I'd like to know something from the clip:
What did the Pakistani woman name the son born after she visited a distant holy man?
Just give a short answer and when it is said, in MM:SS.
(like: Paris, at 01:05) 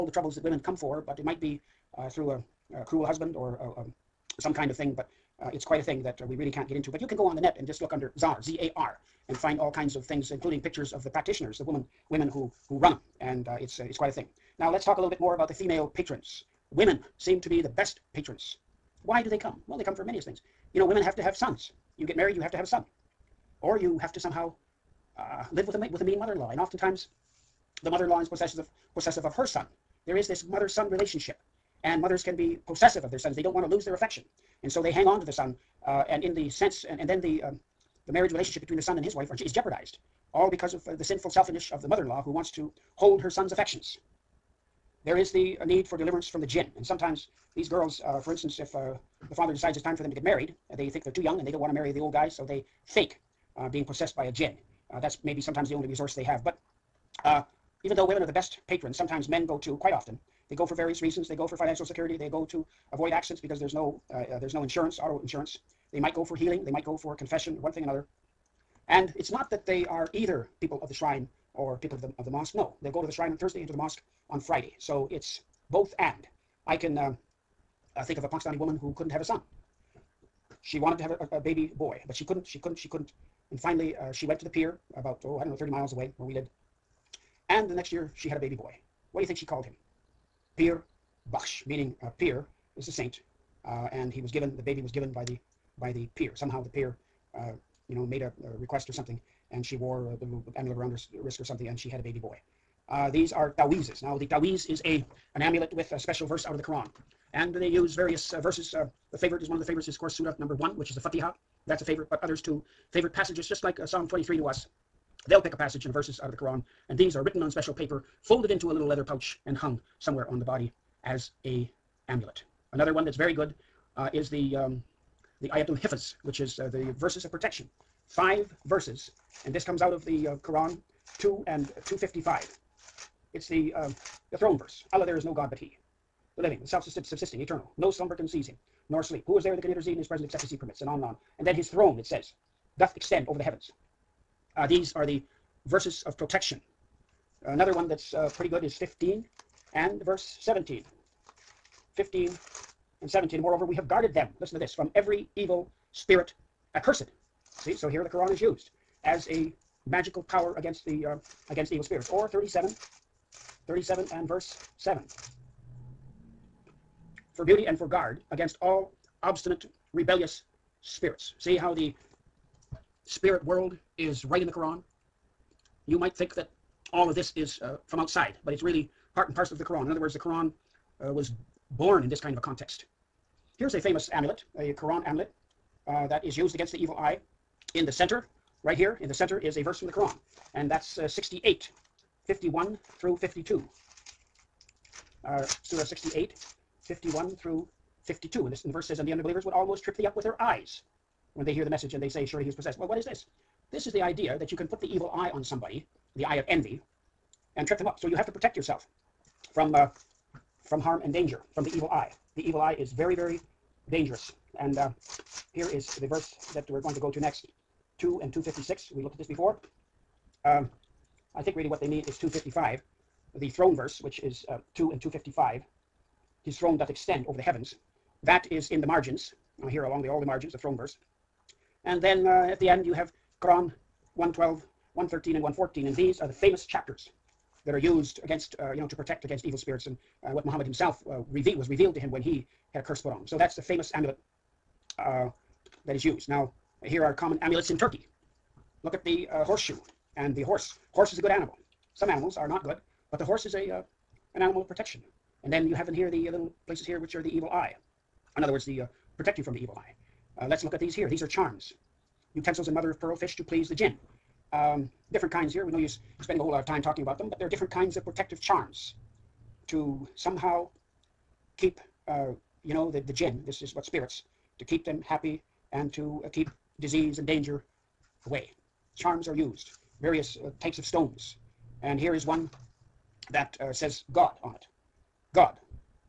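Pir Baksh, at 01:30.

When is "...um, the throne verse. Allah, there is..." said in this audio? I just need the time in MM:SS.
02:13.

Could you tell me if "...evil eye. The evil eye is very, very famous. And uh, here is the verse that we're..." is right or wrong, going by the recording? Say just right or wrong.
wrong.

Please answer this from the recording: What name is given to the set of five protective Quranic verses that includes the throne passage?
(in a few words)
Ayatul Hifaz.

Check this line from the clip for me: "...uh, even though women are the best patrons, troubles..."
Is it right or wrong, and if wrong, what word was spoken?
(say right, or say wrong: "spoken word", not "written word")
wrong: "sometimes", not "troubles".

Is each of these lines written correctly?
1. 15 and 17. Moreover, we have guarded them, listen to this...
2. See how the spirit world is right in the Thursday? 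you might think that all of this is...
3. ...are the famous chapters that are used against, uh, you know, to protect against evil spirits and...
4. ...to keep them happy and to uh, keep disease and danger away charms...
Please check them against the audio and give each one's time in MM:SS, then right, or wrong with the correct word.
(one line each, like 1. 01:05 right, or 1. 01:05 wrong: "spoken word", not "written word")
1. 02:31 right
2. 02:51 wrong: "Quran", not "Thursday"
3. 03:56 right
4. 04:34 right.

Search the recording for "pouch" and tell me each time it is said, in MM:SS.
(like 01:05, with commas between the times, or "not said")
01:59.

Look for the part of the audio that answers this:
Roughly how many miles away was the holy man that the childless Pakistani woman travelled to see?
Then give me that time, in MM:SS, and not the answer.
01:25.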